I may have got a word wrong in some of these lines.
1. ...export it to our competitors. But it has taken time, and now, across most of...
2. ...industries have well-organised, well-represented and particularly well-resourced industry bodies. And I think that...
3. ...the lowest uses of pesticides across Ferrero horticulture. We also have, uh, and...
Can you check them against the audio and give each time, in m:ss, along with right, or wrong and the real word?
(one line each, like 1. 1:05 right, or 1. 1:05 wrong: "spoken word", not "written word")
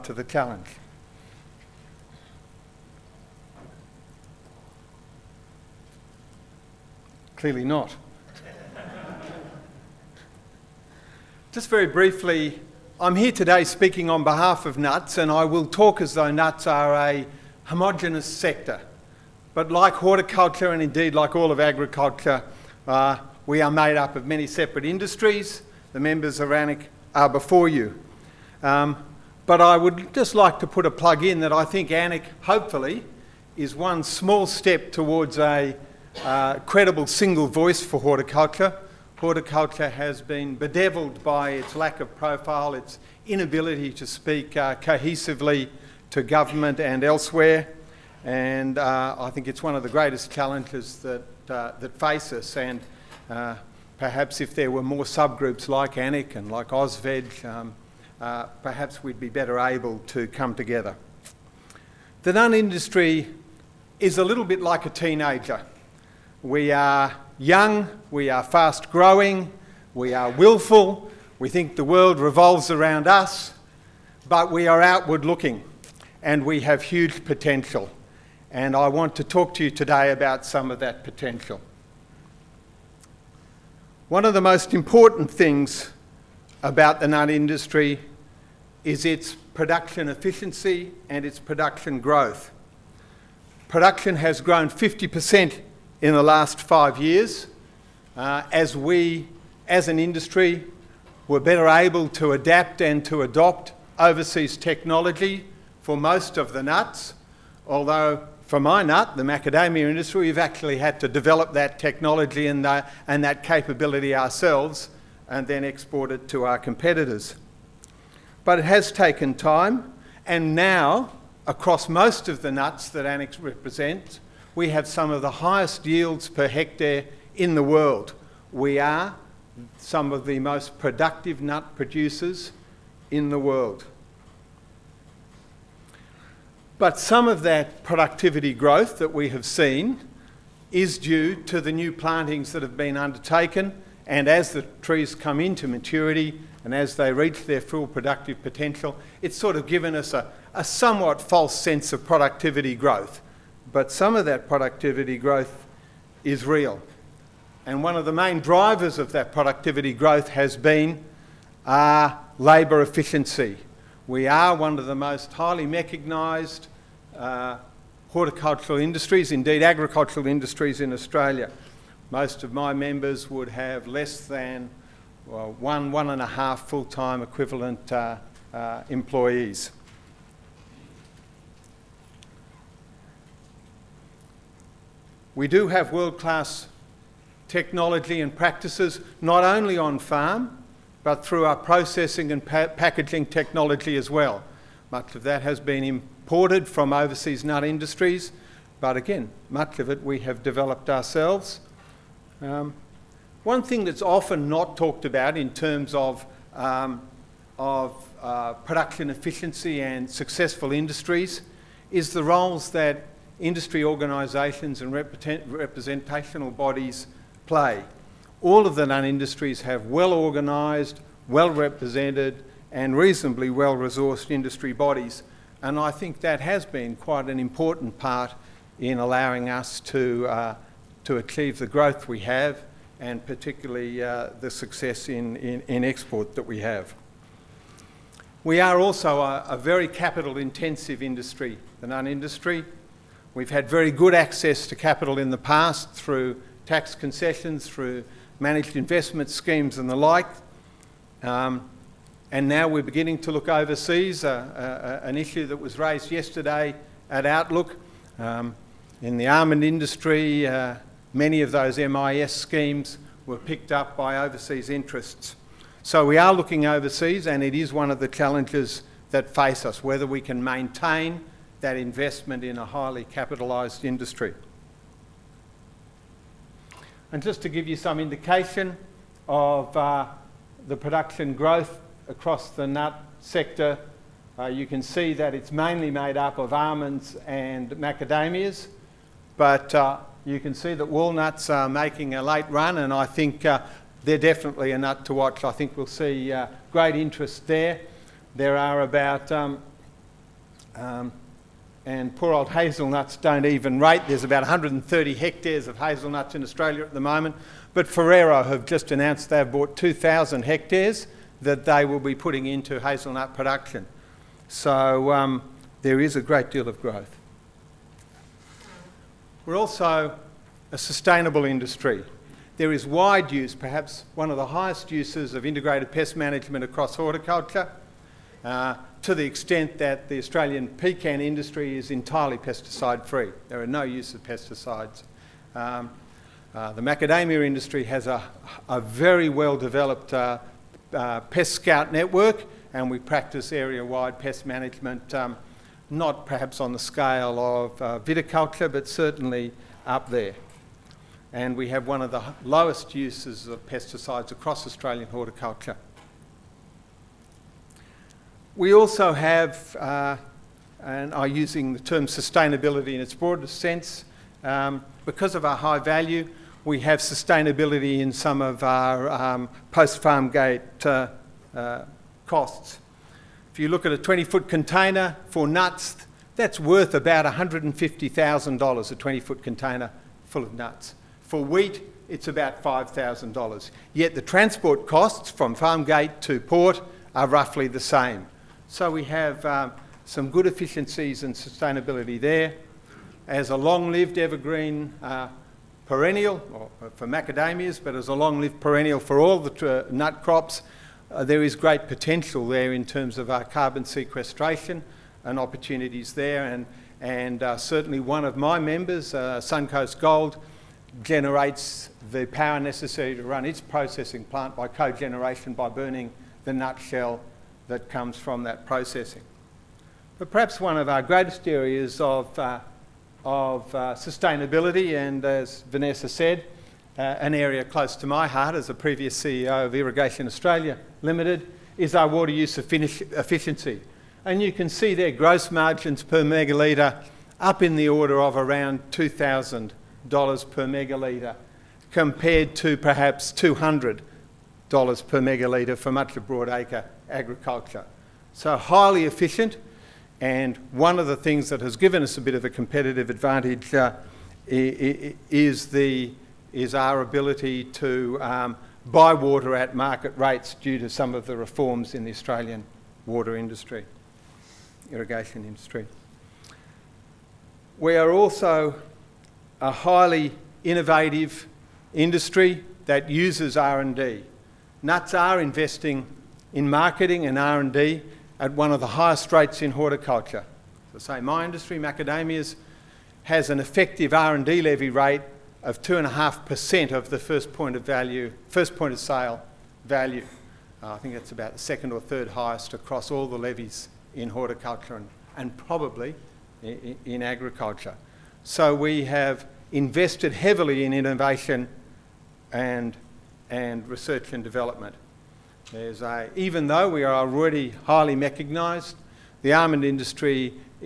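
1. 1:55 right
2. 3:39 wrong: "reasonably", not "particularly"
3. 5:52 wrong: "Australian", not "Ferrero".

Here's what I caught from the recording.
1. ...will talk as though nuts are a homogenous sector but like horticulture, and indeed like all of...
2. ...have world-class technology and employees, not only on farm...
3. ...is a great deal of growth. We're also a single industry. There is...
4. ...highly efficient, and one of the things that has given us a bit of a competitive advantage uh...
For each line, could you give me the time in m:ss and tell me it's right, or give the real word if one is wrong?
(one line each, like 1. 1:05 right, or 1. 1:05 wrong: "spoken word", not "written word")
1. 0:15 right
2. 3:05 wrong: "practices", not "employees"
3. 5:15 wrong: "sustainable", not "single"
4. 7:28 right.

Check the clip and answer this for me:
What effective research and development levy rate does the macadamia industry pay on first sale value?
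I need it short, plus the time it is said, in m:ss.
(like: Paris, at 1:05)
2.5%, at 8:05.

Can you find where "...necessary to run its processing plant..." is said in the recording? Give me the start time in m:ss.
6:52.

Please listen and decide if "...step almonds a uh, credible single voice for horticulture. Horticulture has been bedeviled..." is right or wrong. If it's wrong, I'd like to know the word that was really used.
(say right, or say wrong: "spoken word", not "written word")
wrong: "towards", not "almonds".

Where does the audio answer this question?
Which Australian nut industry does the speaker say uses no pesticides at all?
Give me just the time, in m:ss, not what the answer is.
5:30.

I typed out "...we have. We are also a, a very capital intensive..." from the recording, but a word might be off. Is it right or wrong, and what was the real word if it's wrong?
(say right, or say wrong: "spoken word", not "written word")
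right.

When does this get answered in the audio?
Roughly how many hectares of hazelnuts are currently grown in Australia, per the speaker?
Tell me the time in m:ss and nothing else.
5:04.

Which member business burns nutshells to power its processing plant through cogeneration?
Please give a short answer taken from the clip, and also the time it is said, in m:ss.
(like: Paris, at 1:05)
Suncoast Gold, at 6:49.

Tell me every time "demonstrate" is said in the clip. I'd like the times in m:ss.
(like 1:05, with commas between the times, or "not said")
not said.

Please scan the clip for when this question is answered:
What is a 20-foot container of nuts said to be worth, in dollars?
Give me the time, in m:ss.
6:17.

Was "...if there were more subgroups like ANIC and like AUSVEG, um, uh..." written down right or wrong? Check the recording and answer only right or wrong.
right.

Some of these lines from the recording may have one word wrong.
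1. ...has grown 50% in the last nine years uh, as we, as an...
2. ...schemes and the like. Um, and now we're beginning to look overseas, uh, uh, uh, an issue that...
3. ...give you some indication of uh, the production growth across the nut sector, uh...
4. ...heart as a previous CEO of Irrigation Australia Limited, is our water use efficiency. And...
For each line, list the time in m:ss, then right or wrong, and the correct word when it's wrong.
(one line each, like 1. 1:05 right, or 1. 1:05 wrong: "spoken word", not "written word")
1. 1:34 wrong: "five", not "nine"
2. 4:09 right
3. 4:37 right
4. 7:08 right.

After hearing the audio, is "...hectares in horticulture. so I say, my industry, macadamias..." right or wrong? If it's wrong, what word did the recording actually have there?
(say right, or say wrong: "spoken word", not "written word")
wrong: "rates", not "hectares".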